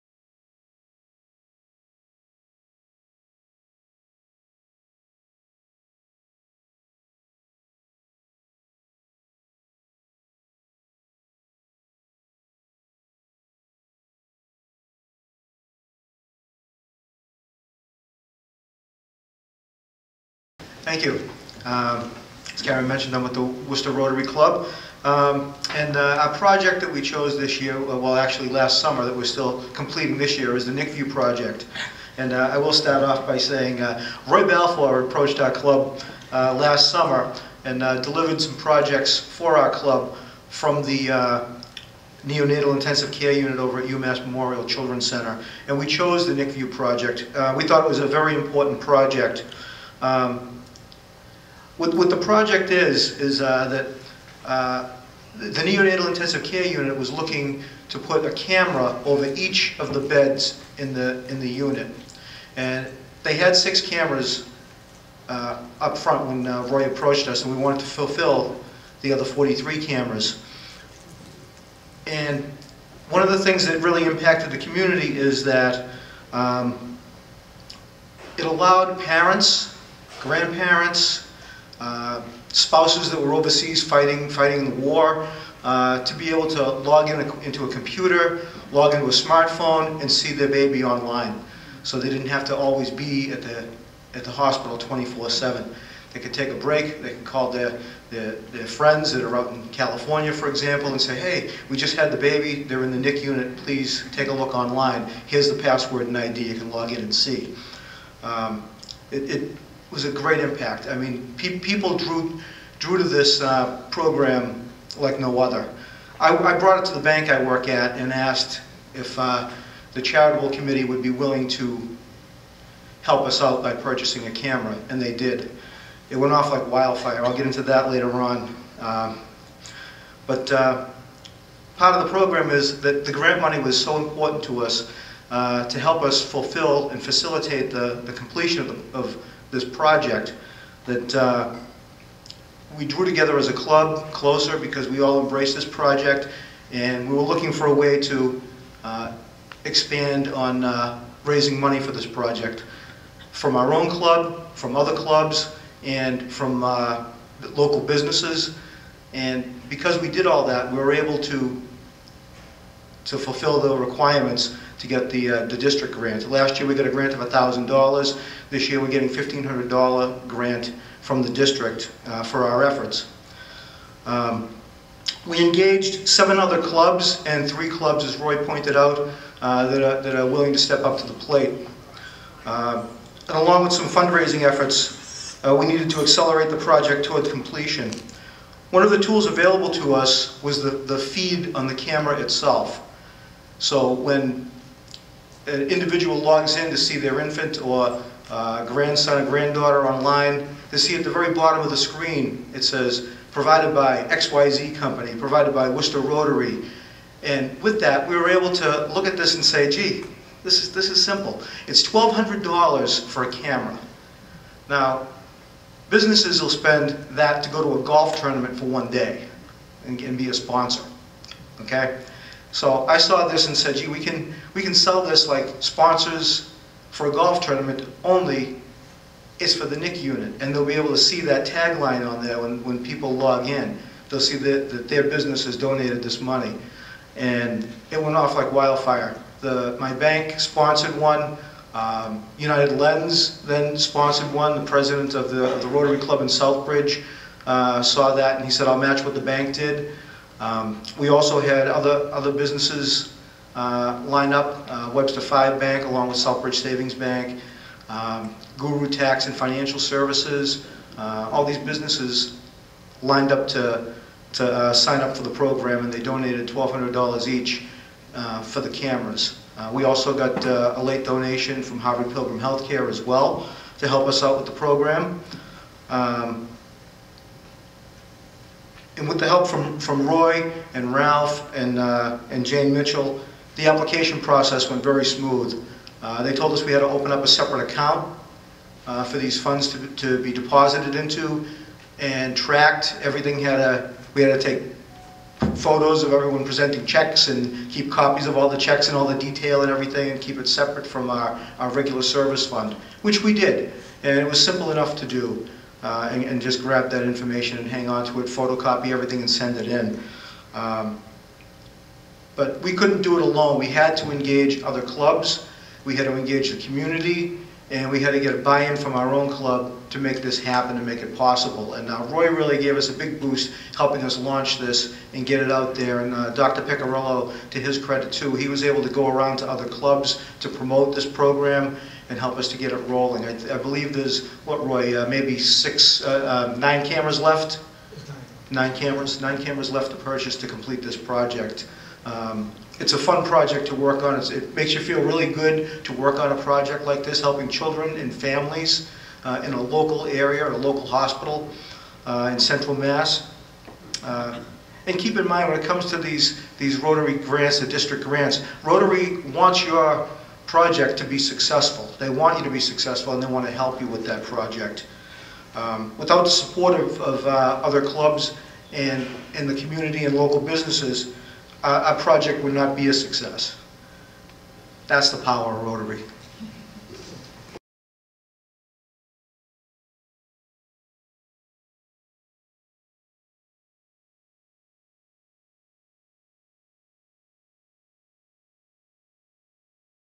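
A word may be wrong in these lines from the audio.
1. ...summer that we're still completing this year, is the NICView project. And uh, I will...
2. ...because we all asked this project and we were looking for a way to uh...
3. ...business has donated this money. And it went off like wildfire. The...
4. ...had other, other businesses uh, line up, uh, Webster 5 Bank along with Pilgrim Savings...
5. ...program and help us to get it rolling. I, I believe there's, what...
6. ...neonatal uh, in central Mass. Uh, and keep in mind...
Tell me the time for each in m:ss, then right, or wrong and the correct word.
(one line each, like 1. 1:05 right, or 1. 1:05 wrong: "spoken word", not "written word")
1. 0:28 right
2. 2:24 wrong: "embraced", not "asked"
3. 3:55 right
4. 4:11 wrong: "Southbridge", not "Pilgrim"
5. 5:31 right
6. 5:50 wrong: "hospital", not "neonatal".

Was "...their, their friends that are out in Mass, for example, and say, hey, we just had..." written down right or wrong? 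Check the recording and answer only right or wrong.
wrong.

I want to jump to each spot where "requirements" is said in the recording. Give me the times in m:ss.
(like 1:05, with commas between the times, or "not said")
2:43.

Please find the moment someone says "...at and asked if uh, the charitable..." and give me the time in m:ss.
1:57.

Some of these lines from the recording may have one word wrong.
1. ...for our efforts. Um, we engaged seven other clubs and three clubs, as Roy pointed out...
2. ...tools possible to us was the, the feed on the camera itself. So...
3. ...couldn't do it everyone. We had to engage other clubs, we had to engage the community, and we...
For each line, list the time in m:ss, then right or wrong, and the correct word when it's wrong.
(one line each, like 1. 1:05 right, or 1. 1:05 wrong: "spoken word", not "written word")
1. 2:52 right
2. 3:08 wrong: "available", not "possible"
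3. 5:12 wrong: "alone", not "everyone".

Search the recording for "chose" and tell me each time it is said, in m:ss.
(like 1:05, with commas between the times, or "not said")
0:27, 0:45.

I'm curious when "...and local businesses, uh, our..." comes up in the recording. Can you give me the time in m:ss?
6:10.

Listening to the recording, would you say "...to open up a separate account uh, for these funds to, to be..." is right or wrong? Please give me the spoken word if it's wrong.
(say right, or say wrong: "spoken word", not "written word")
right.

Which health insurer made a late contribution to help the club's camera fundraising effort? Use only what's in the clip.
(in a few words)
Harvard Pilgrim Healthcare.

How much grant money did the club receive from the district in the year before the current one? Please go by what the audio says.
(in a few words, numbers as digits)
$1,000.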